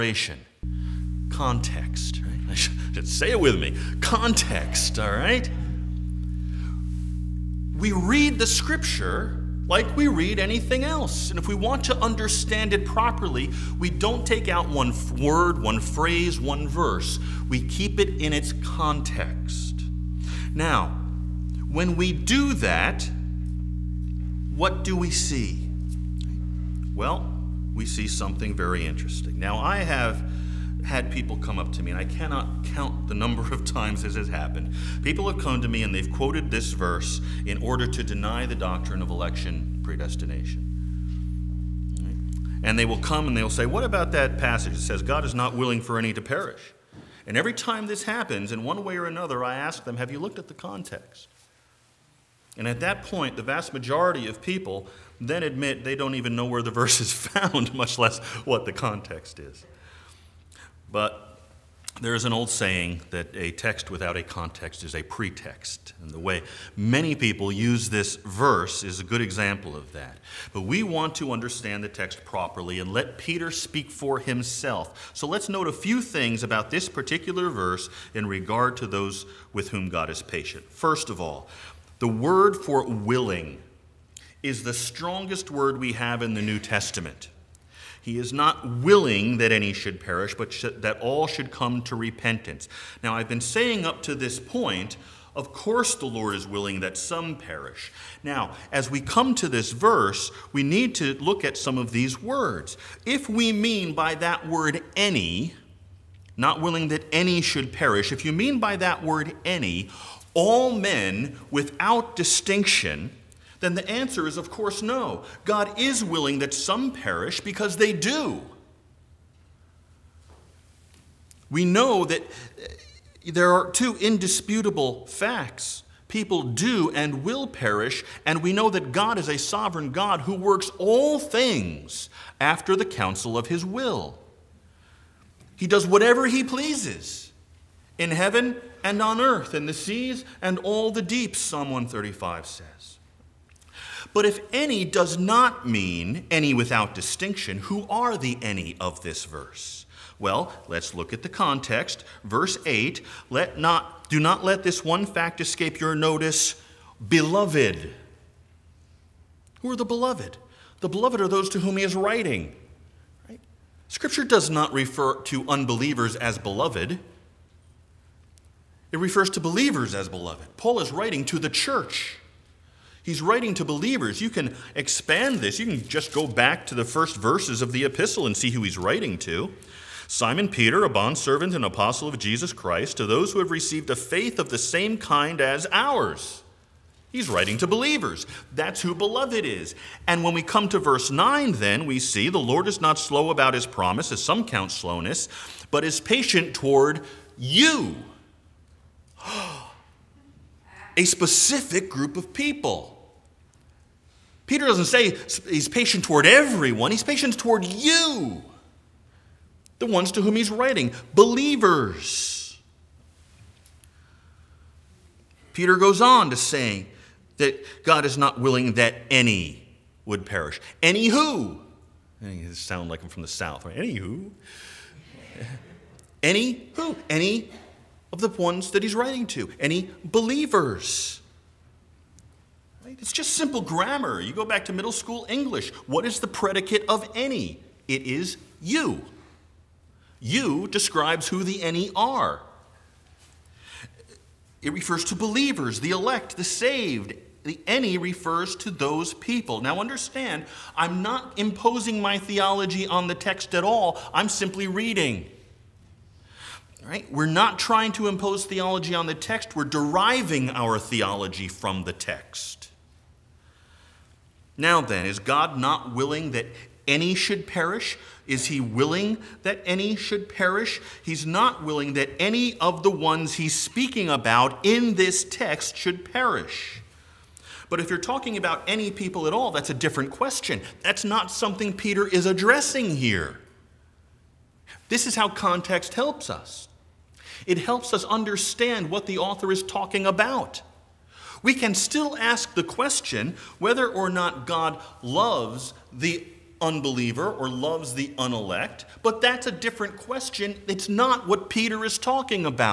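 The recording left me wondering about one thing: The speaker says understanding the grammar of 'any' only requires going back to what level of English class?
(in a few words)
middle school.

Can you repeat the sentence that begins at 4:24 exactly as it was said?
Now then, is God not willing that any should perish?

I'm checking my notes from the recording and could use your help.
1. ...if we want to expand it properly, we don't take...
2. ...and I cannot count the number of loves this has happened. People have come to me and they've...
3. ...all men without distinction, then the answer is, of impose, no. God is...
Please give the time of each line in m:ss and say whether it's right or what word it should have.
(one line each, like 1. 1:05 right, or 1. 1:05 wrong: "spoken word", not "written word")
1. 0:11 wrong: "understand", not "expand"
2. 0:31 wrong: "times", not "loves"
3. 1:50 wrong: "course", not "impose".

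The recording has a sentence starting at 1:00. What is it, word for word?
But there is an old saying that a text without a context is a pretext.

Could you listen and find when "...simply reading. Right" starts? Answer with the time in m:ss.
4:14.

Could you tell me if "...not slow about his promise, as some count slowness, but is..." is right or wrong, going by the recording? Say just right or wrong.
right.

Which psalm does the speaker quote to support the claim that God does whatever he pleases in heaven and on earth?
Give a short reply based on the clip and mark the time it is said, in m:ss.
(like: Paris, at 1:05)
Psalm 135, at 2:21.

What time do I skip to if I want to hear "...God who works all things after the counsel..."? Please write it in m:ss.
2:09.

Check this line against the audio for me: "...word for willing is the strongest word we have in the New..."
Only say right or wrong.
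right.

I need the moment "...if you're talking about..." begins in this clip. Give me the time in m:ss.
4:37.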